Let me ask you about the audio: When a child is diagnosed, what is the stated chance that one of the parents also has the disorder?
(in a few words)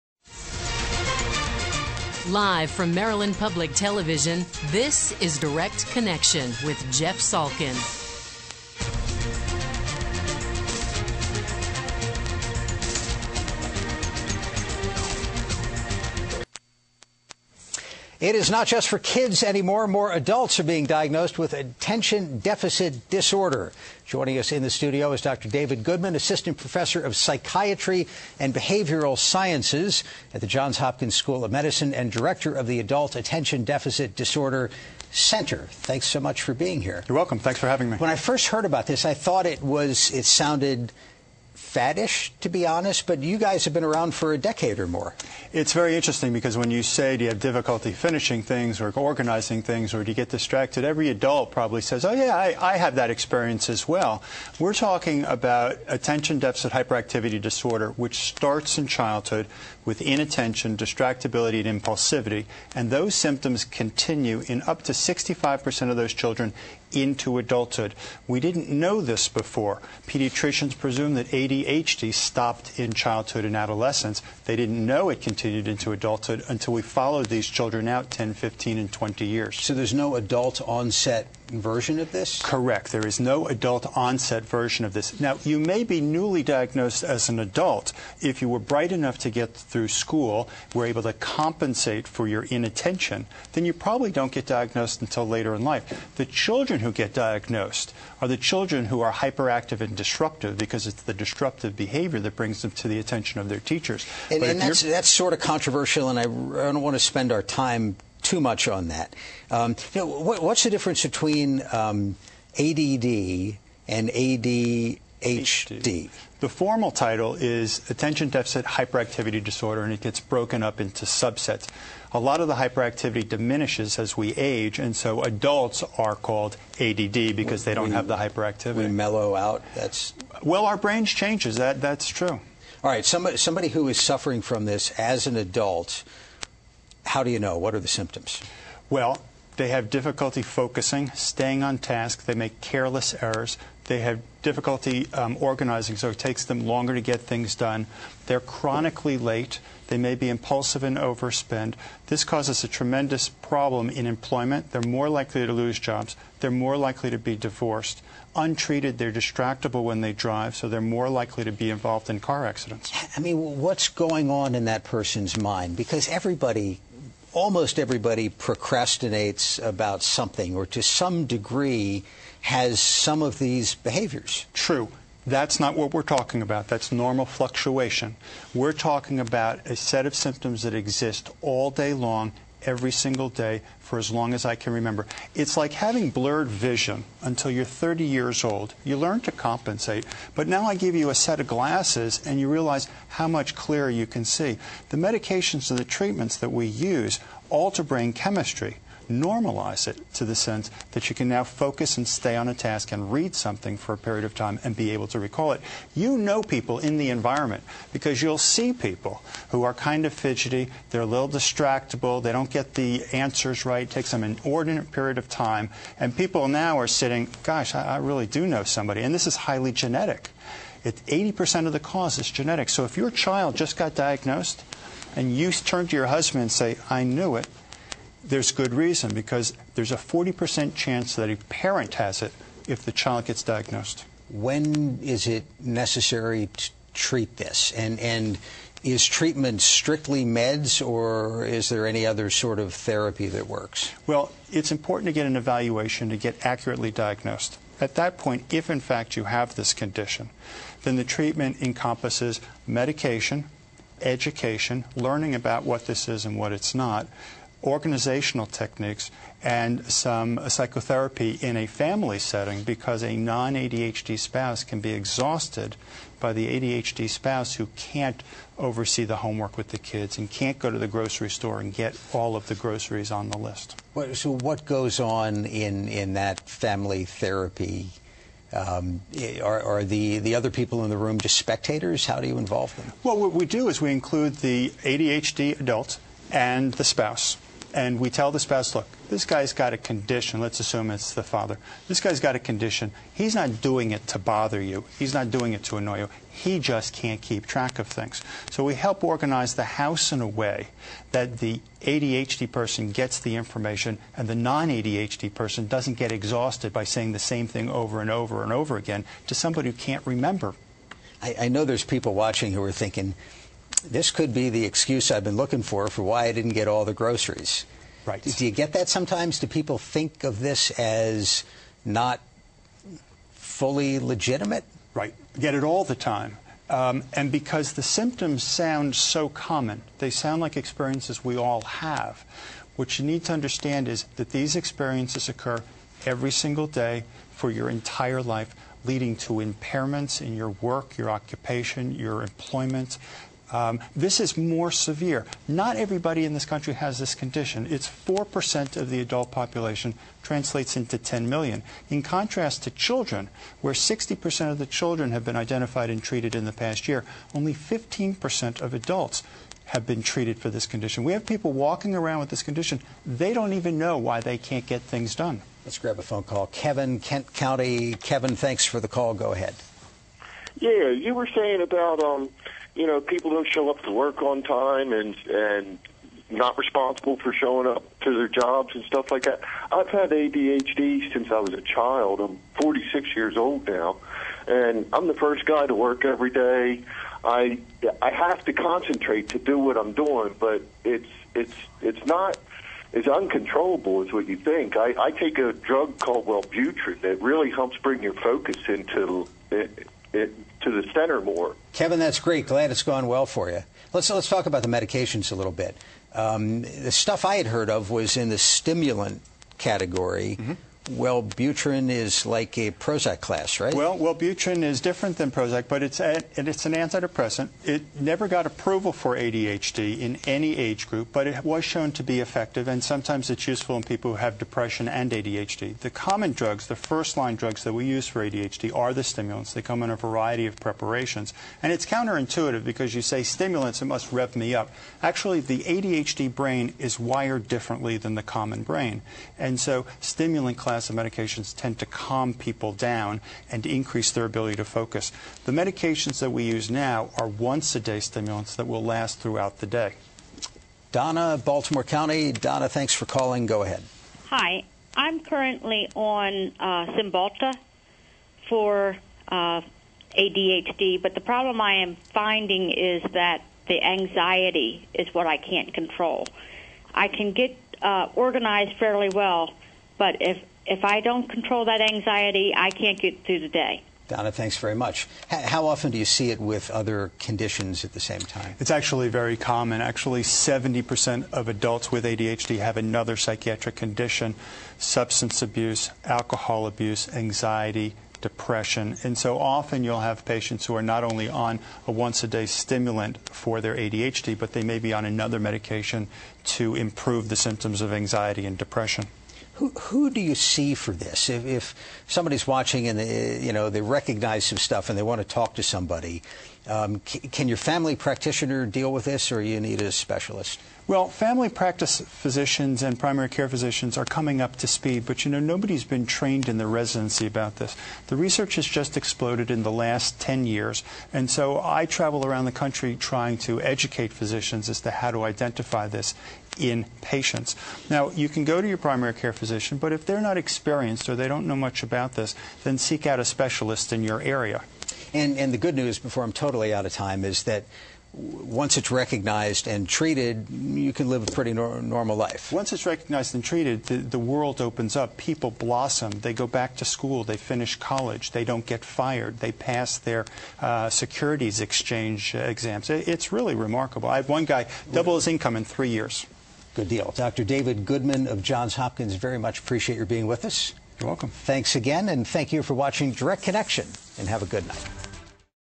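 40%.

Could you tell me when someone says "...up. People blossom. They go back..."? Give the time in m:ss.
9:04.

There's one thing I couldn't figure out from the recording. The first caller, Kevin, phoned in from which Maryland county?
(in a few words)
Kent County.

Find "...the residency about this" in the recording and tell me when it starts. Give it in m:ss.
8:36.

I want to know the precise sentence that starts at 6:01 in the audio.
We have people walking around with this condition.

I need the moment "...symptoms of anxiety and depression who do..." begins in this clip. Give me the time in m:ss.
8:17.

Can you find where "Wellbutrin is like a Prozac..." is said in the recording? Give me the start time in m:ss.
6:50.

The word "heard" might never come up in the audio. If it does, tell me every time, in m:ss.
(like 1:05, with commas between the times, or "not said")
0:38, 6:47.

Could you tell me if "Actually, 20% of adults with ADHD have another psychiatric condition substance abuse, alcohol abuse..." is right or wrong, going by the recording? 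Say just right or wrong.
wrong.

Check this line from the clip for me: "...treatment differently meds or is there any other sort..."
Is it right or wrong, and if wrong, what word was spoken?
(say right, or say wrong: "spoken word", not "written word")
wrong: "strictly", not "differently".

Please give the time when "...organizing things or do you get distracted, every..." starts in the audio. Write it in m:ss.
0:48.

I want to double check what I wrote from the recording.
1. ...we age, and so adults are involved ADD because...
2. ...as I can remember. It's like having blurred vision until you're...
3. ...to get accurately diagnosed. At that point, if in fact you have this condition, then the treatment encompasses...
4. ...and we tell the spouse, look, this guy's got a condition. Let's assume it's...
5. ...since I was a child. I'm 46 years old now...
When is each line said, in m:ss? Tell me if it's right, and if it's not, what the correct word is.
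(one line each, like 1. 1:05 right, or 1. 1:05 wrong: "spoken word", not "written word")
1. 2:04 wrong: "called", not "involved"
2. 3:04 right
3. 4:06 right
4. 4:47 right
5. 6:21 right.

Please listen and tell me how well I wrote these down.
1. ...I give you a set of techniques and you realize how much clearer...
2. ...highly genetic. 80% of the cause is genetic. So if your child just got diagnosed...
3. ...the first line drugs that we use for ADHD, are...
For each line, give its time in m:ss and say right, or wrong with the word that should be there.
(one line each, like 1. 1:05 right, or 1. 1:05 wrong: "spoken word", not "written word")
1. 3:10 wrong: "glasses", not "techniques"
2. 3:39 right
3. 7:06 right.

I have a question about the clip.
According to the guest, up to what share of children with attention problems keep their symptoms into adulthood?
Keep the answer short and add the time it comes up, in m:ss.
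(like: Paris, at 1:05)
65%, at 1:04.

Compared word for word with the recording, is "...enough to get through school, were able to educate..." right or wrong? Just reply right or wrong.
wrong.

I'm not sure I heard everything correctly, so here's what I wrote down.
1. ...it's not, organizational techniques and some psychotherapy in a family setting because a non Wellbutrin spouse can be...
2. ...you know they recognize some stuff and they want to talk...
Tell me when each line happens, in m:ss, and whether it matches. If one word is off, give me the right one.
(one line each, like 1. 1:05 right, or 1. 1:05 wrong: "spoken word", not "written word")
1. 4:16 wrong: "ADHD", not "Wellbutrin"
2. 8:23 right.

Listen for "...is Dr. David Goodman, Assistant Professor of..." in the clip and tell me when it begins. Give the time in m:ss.
0:25.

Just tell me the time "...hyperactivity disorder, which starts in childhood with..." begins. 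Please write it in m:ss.
0:56.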